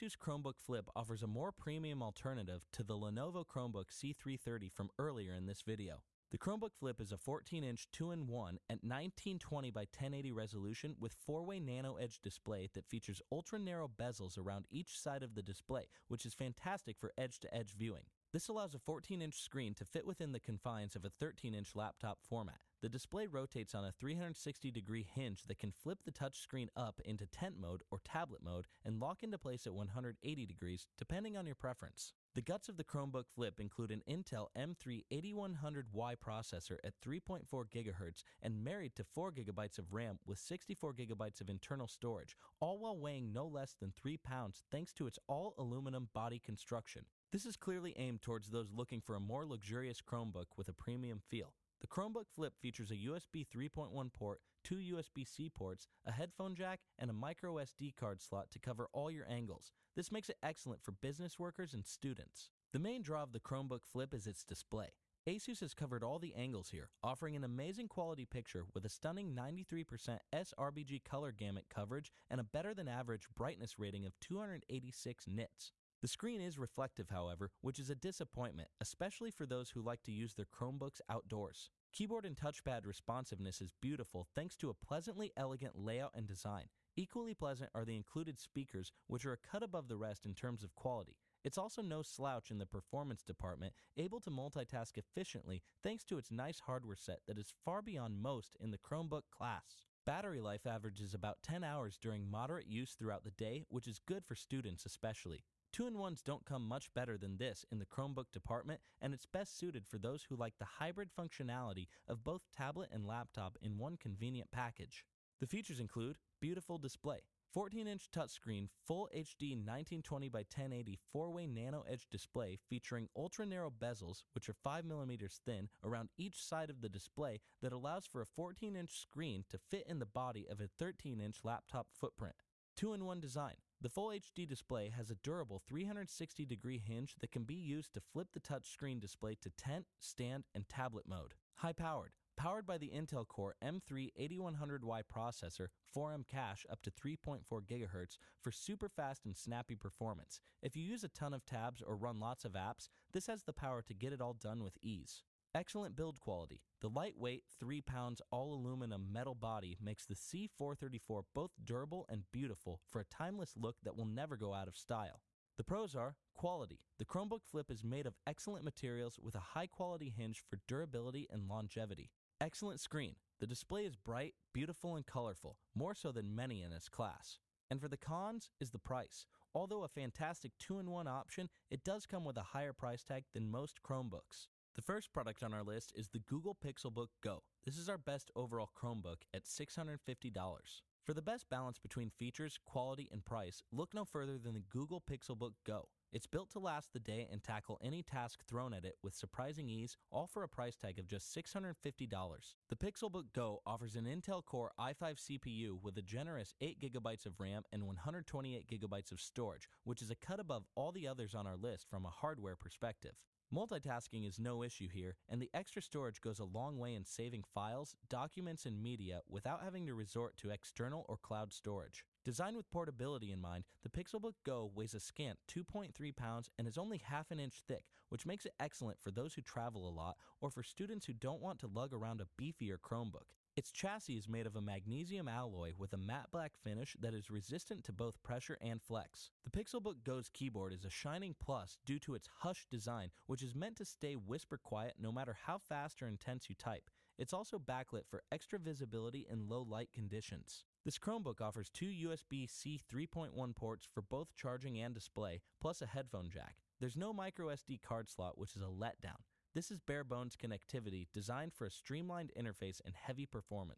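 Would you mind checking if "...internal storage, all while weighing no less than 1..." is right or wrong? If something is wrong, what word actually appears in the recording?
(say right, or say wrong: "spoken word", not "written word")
wrong: "3", not "1".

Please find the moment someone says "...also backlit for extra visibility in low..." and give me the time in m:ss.
4:07.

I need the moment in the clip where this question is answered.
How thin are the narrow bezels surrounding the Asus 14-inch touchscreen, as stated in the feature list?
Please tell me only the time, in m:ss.
2:04.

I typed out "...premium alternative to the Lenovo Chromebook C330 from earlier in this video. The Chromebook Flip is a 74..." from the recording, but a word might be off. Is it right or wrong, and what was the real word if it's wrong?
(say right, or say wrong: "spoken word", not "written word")
wrong: "14", not "74".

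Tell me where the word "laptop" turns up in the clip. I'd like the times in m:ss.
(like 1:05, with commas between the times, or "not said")
0:21, 1:53, 2:11.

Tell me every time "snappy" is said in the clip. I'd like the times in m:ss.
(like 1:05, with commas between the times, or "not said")
2:29.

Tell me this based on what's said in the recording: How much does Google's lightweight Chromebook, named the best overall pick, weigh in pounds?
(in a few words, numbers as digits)
2.3 pounds.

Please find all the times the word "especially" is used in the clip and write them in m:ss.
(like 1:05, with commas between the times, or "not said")
1:18, 1:44.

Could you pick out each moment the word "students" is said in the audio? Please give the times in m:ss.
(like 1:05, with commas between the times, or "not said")
1:01, 1:44, 3:50.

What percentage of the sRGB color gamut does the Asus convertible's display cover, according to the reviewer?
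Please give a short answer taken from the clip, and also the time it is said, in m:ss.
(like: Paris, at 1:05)
93%, at 1:09.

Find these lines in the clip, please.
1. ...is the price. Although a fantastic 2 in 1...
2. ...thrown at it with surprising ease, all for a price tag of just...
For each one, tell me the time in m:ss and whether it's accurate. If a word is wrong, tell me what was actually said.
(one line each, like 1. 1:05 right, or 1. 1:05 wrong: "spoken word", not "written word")
1. 2:58 right
2. 3:18 right.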